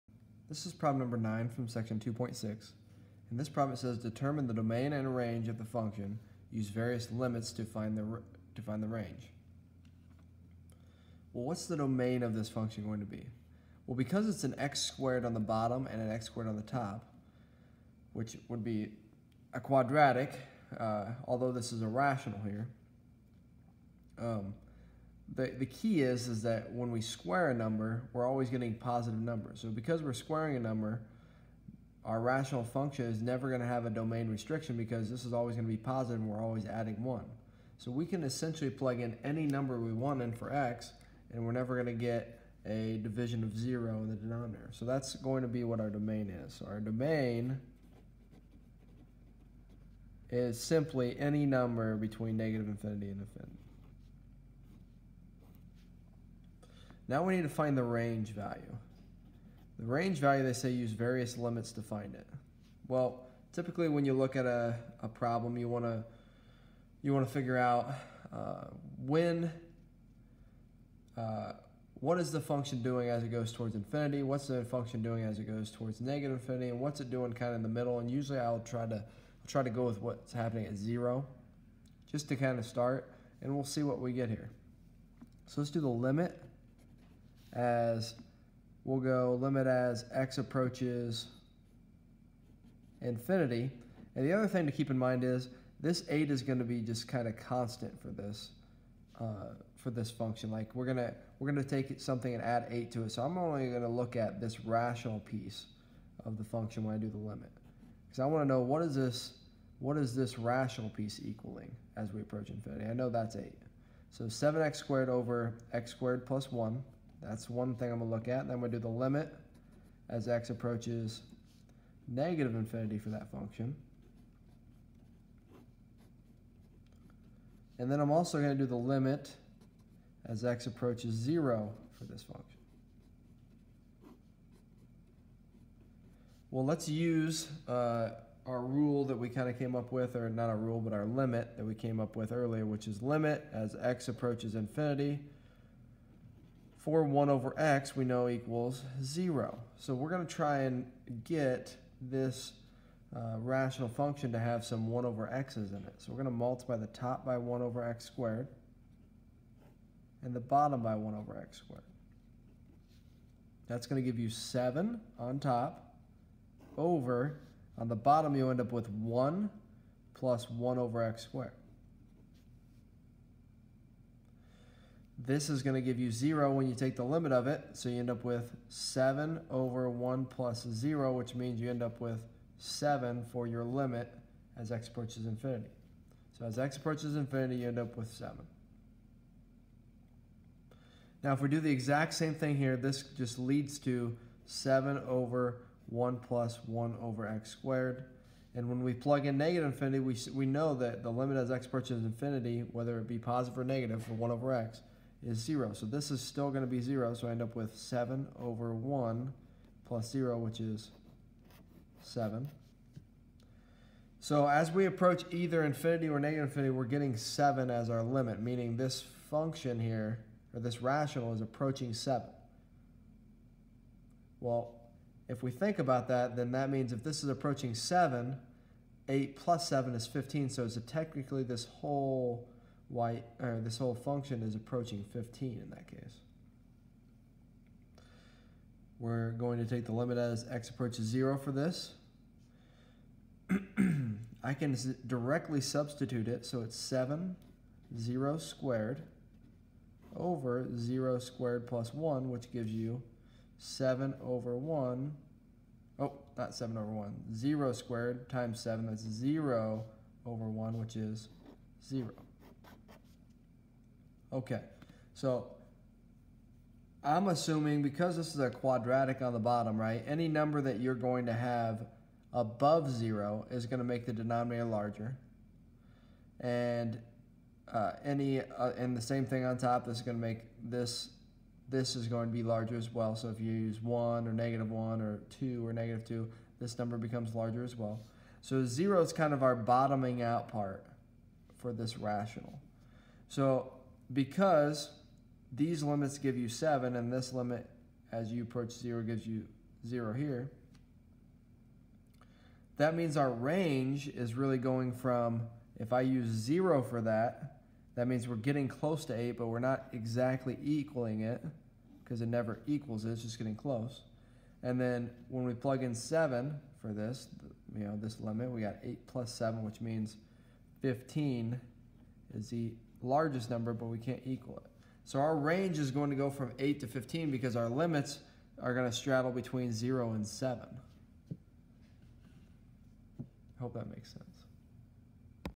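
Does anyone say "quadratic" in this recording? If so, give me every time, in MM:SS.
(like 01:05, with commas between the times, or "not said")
00:19, 04:28.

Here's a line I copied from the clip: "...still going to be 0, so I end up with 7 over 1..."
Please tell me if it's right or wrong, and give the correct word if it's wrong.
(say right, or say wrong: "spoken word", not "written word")
right.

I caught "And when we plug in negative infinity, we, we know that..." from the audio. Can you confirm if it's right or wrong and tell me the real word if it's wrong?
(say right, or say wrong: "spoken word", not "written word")
right.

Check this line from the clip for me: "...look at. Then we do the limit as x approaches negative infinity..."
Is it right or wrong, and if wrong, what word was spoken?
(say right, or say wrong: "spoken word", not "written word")
right.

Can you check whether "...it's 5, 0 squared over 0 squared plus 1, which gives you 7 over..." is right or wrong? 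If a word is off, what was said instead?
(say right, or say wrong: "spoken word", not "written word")
wrong: "7", not "5".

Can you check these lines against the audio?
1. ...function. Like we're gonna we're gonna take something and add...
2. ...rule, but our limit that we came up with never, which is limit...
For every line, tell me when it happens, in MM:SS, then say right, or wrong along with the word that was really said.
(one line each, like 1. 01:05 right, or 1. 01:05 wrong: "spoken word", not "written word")
1. 01:40 right
2. 02:20 wrong: "earlier", not "never".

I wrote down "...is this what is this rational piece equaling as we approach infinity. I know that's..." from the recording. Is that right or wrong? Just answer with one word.
right.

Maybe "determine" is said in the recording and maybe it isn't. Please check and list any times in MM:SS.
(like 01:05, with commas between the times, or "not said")
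00:03.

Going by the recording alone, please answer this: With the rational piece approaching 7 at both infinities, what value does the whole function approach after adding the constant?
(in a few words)
15.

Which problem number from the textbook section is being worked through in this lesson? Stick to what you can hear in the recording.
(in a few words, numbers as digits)
9.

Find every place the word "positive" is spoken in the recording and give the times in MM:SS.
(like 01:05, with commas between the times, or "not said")
00:28, 00:35, 03:23.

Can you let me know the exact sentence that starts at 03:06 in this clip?
So as x approaches infinity, you end up with 7.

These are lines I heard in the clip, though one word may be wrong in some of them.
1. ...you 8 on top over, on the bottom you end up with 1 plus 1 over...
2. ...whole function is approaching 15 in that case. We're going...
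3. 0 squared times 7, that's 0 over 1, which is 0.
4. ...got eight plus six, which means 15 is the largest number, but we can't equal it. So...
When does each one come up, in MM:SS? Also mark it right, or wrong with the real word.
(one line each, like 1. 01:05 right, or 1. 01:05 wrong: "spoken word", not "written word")
1. 02:44 wrong: "7", not "8"
2. 03:53 right
3. 04:17 right
4. 05:18 wrong: "seven", not "six".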